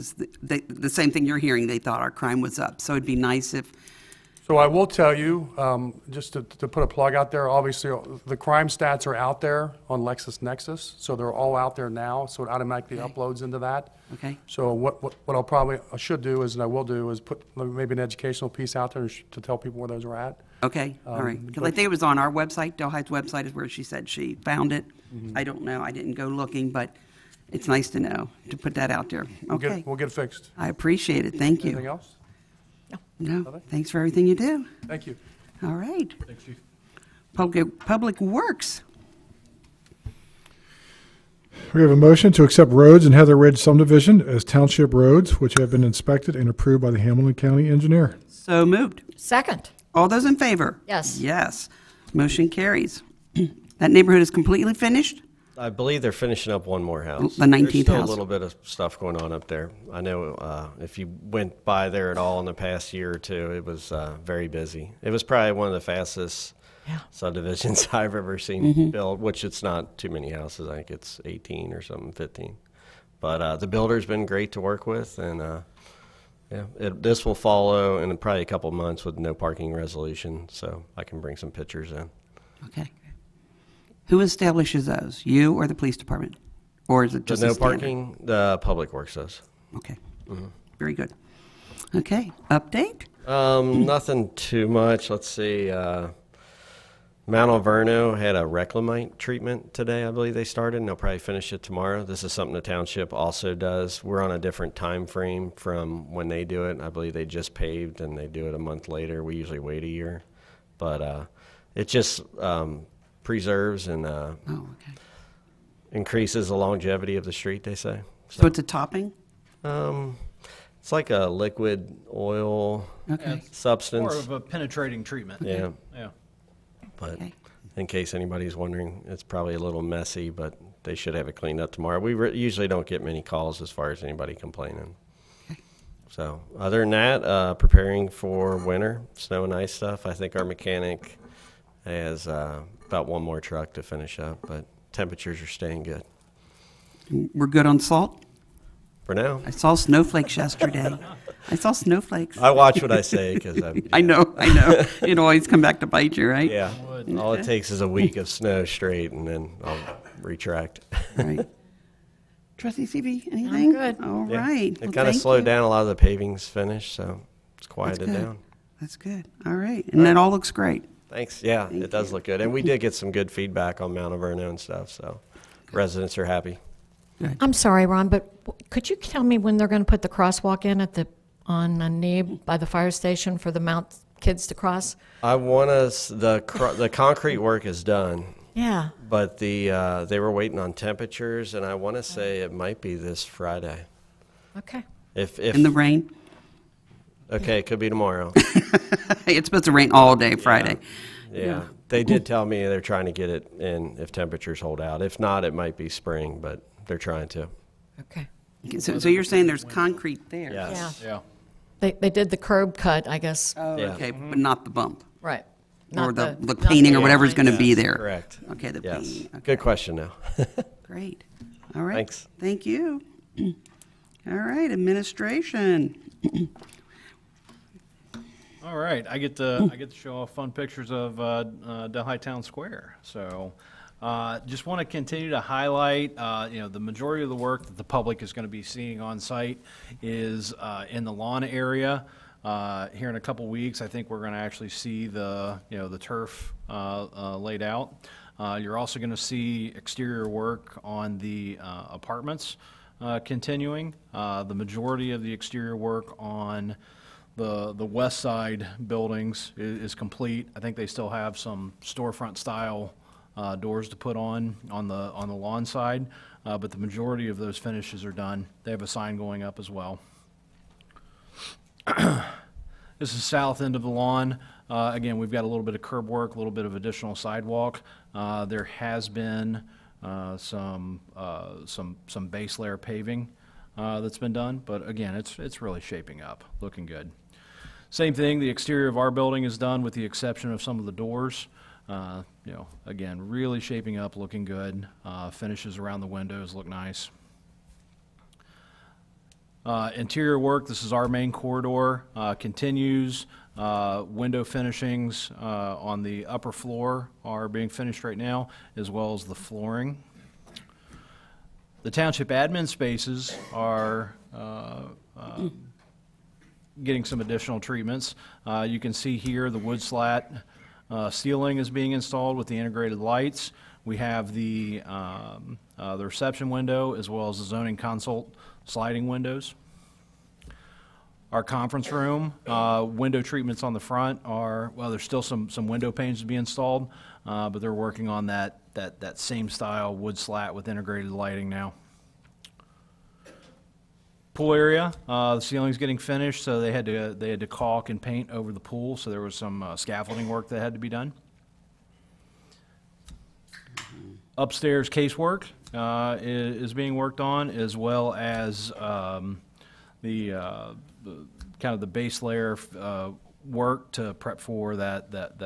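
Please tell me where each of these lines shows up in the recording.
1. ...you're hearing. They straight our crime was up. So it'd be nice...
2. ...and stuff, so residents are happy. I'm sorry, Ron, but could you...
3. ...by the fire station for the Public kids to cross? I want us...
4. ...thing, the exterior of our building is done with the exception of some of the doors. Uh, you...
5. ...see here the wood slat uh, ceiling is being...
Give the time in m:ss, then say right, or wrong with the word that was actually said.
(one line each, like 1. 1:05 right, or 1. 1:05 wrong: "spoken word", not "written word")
1. 0:01 wrong: "thought", not "straight"
2. 2:54 right
3. 3:02 wrong: "Mount", not "Public"
4. 4:48 right
5. 5:18 right.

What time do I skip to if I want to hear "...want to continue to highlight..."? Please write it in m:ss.
3:54.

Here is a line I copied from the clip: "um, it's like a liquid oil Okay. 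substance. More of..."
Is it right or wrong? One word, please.
right.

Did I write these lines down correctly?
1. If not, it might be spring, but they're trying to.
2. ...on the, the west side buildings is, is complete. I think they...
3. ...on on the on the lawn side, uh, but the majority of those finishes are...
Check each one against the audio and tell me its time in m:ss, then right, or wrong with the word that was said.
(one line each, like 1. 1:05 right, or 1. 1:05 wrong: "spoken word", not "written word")
1. 3:25 right
2. 4:16 right
3. 4:24 right.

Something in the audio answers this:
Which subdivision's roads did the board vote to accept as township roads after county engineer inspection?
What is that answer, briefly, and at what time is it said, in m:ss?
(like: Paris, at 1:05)
Heather Ridge, at 0:43.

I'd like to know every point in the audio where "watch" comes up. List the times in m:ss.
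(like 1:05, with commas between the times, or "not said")
2:32.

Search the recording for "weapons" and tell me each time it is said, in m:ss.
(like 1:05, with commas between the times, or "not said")
not said.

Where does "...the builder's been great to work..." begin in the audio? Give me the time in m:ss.
1:13.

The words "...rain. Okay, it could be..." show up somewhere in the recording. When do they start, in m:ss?
3:15.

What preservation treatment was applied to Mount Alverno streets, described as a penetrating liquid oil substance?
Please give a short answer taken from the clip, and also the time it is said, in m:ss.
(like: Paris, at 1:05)
reclamite treatment, at 1:38.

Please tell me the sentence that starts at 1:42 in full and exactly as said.
This is something the township also does.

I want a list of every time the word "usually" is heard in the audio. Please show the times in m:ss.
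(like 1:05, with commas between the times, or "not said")
1:49, 2:12.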